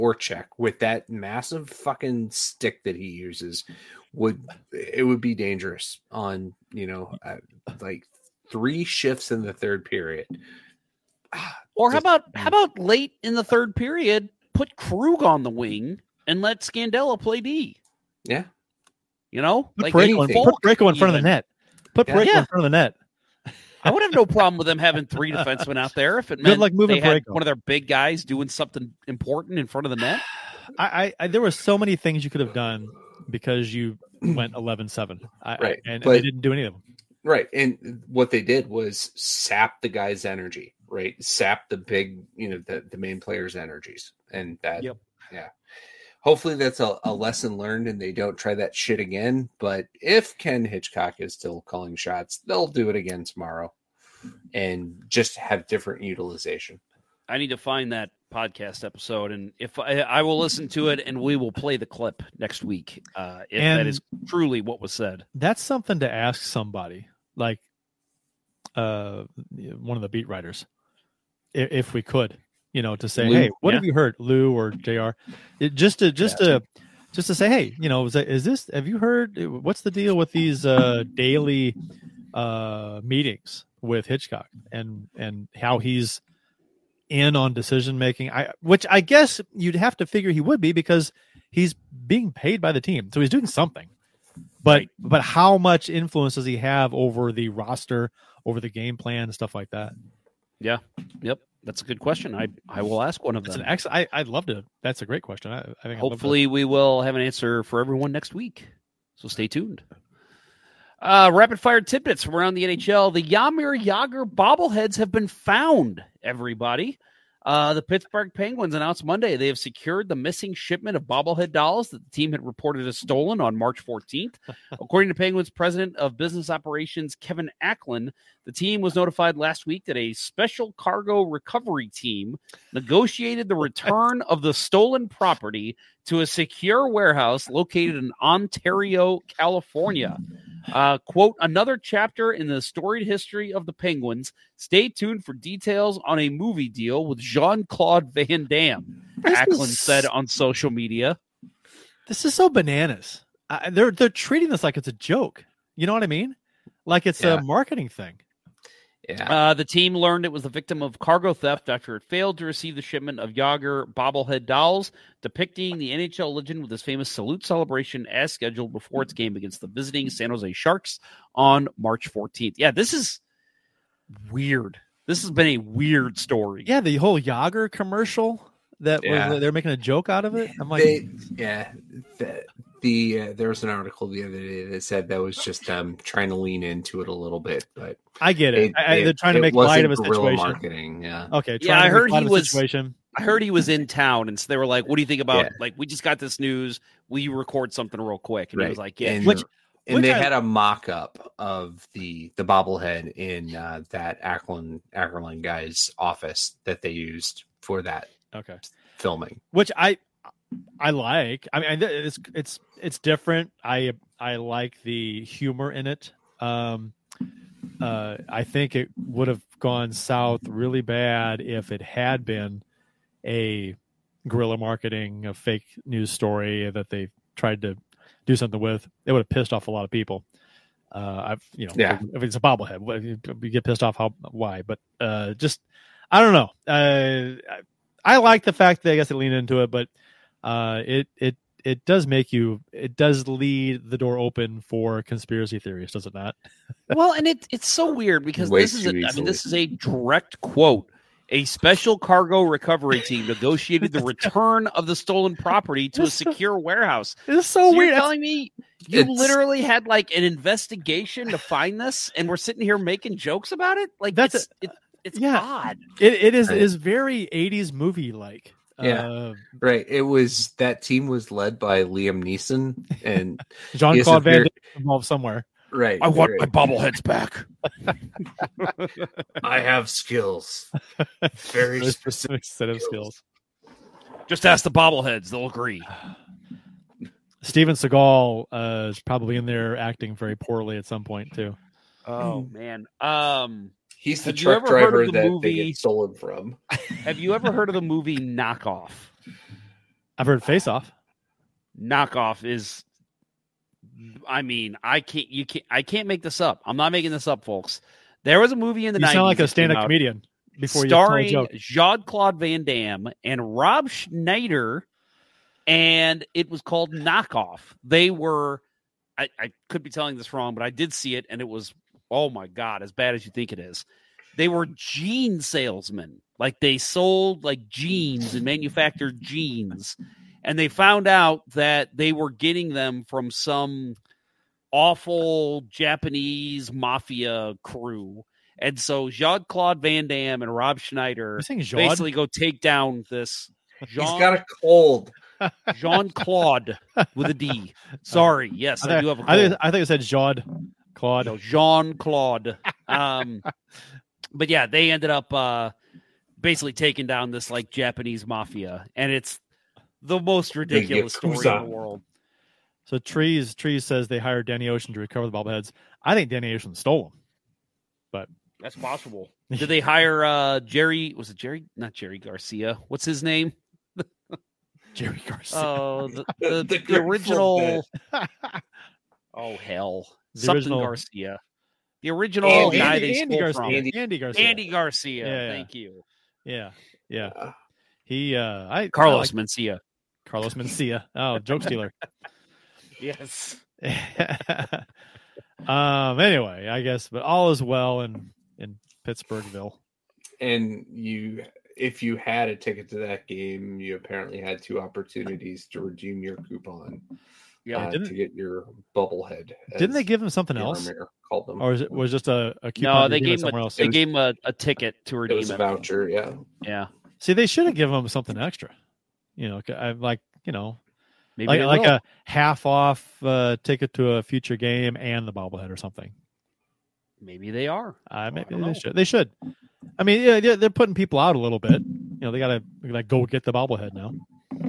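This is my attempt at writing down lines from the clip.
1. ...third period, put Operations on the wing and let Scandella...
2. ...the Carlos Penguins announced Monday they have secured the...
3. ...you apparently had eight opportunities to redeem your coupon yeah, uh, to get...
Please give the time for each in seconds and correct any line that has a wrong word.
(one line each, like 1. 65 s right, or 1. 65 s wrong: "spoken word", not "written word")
1. 13 s wrong: "Krug", not "Operations"
2. 117 s wrong: "Pittsburgh", not "Carlos"
3. 403 s wrong: "two", not "eight".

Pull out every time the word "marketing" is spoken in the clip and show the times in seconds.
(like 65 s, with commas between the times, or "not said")
157 s, 190 s, 224 s.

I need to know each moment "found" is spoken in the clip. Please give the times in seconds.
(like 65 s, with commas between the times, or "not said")
115 s, 330 s.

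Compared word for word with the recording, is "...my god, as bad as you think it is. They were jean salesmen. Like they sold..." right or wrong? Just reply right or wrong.
right.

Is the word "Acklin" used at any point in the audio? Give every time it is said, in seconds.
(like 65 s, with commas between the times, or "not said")
127 s, 149 s.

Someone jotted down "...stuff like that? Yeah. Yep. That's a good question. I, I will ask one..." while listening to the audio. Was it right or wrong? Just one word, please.
right.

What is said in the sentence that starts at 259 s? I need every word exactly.
literally had like an investigation to find this, and we're sitting here making jokes about it.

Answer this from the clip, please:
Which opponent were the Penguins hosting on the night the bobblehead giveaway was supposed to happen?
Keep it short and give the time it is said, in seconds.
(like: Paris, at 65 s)
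San Jose Sharks, at 170 s.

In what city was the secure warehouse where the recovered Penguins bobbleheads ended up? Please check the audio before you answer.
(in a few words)
Ontario, California.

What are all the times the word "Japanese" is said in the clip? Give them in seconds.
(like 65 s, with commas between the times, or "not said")
335 s, 357 s.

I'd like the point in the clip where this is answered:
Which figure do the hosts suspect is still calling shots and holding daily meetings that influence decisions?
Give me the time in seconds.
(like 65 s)
50 s.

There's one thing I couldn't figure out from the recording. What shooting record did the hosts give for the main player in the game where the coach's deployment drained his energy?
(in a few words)
11-7.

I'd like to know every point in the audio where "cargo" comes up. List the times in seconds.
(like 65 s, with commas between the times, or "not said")
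130 s, 160 s, 251 s.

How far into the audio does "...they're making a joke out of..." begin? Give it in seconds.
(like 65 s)
179 s.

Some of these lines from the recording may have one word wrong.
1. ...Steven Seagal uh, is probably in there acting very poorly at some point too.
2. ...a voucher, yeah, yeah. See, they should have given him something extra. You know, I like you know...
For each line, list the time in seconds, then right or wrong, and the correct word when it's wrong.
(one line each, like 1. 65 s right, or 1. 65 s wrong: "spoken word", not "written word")
1. 287 s right
2. 415 s right.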